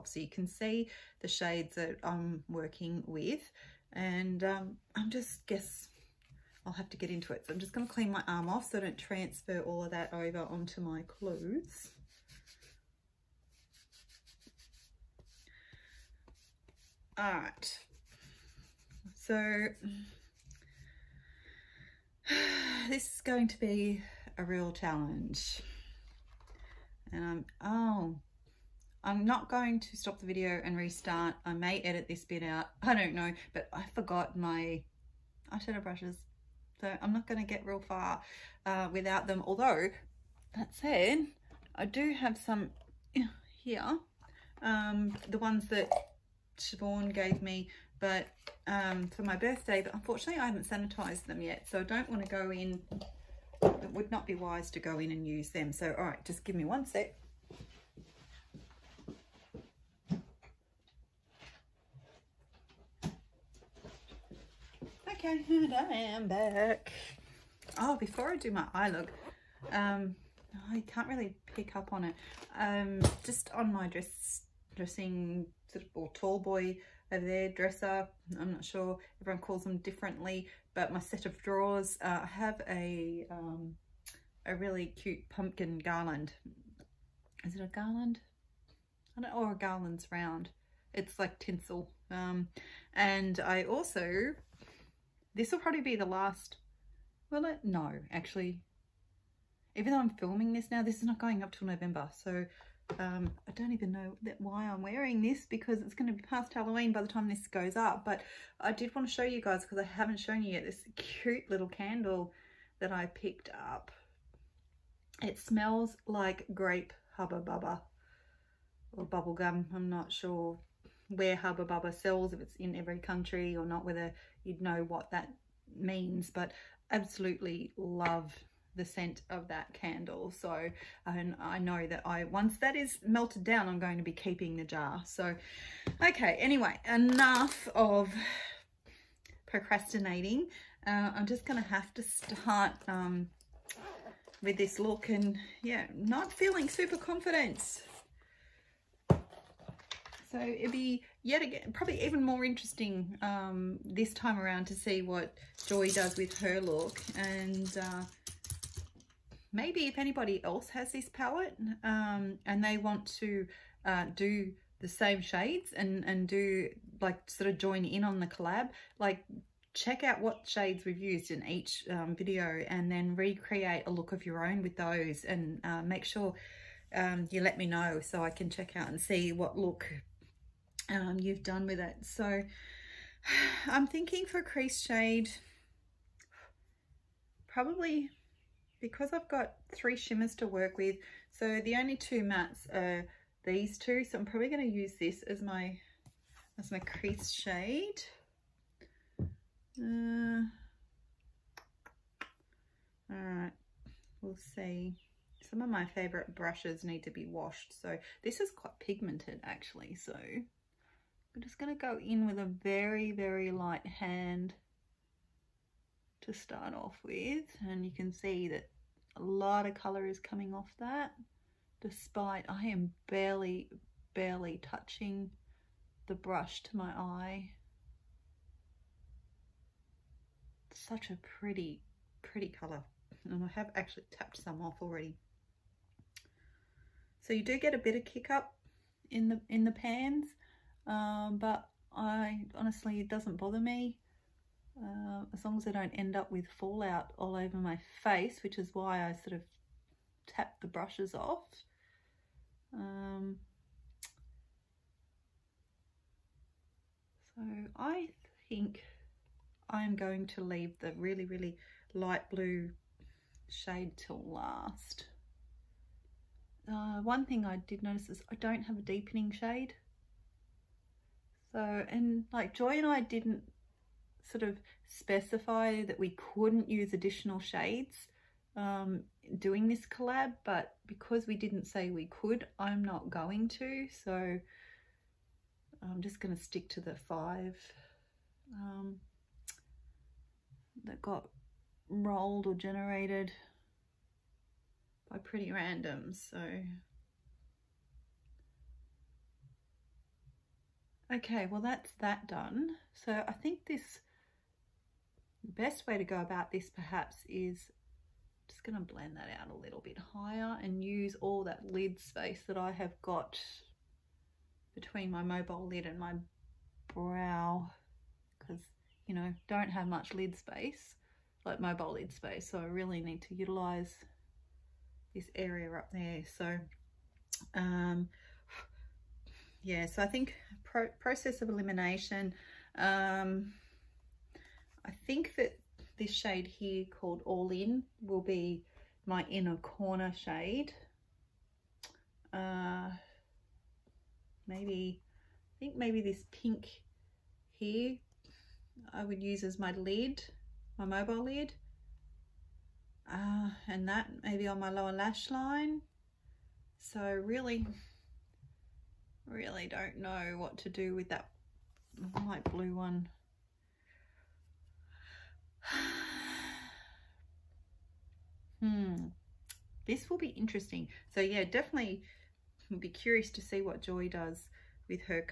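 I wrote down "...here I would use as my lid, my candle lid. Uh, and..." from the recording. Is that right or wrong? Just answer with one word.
wrong.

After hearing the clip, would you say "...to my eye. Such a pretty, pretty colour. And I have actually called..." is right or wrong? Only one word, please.
wrong.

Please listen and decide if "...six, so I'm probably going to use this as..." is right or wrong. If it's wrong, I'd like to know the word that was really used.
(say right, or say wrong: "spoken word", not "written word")
wrong: "two", not "six".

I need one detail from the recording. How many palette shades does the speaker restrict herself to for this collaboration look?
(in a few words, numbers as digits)
5.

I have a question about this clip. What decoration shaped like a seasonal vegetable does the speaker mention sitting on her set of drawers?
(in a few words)
Pumpkin garland.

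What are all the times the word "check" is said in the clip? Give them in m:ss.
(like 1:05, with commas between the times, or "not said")
2:49, 2:58.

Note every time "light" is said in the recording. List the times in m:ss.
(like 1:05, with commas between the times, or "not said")
3:33, 4:21, 6:02.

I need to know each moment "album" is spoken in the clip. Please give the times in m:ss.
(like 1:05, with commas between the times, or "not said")
not said.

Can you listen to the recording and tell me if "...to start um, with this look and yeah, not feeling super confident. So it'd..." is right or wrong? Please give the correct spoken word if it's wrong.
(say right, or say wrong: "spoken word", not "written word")
right.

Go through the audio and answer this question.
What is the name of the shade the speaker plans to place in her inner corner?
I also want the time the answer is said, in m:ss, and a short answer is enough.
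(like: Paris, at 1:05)
All In, at 5:37.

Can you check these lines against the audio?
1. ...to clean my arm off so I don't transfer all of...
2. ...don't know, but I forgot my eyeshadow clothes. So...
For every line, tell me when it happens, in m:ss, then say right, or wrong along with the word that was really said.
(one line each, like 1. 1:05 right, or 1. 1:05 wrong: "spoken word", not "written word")
1. 0:07 right
2. 0:32 wrong: "brushes", not "clothes".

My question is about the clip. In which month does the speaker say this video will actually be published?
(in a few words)
November.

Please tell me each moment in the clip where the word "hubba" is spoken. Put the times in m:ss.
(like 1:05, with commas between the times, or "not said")
1:57, 2:01.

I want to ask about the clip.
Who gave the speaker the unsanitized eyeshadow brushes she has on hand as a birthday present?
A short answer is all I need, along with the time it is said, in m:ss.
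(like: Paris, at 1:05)
Siobhan, at 0:46.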